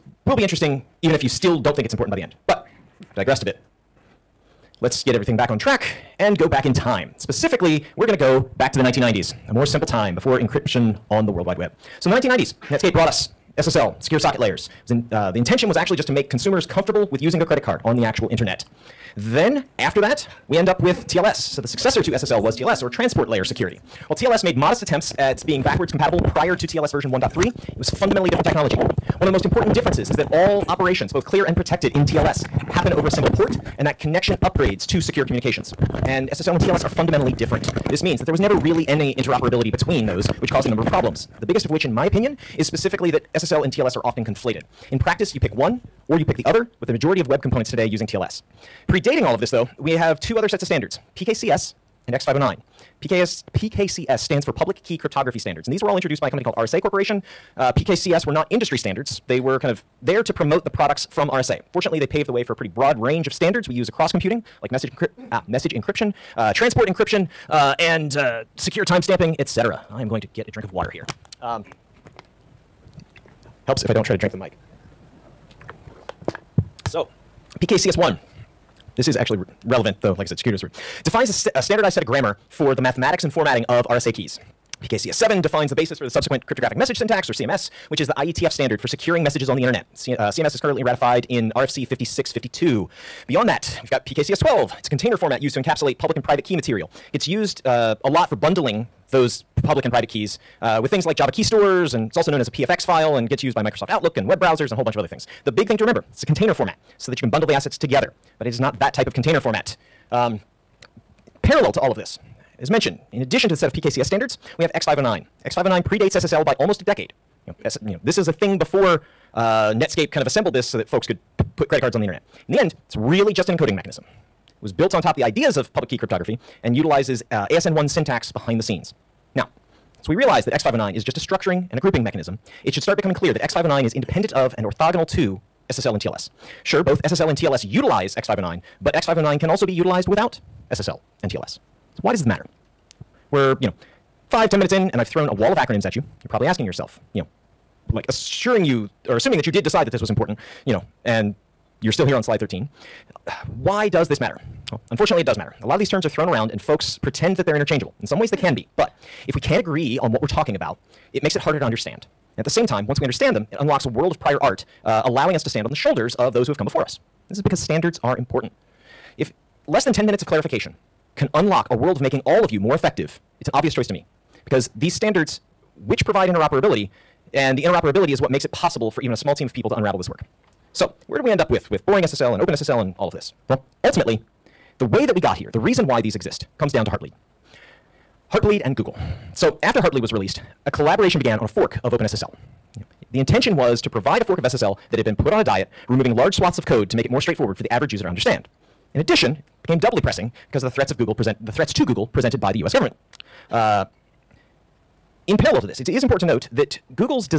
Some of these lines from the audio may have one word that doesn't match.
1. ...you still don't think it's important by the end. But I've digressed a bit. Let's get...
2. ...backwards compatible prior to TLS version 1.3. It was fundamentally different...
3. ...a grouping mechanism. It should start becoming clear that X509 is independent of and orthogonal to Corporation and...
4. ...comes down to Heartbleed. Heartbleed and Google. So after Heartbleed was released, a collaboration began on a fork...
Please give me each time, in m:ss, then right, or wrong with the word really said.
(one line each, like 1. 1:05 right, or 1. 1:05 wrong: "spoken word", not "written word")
1. 0:01 right
2. 0:25 right
3. 2:11 wrong: "SSL", not "Corporation"
4. 3:06 right.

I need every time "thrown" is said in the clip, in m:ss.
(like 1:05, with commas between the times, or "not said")
2:25, 2:36.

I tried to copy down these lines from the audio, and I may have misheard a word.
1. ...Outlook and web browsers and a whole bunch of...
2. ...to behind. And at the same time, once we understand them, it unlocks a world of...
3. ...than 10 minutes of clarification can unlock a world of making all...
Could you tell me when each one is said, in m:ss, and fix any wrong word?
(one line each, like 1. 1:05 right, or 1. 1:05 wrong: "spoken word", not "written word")
1. 1:43 right
2. 2:41 wrong: "understand", not "behind"
3. 2:49 right.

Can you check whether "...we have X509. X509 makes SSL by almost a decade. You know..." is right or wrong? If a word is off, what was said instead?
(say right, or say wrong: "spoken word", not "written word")
wrong: "predates", not "makes".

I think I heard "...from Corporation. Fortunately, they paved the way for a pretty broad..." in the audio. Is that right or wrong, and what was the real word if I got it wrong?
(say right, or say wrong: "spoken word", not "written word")
wrong: "RSA", not "Corporation".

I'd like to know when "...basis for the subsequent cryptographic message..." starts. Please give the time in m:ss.
1:25.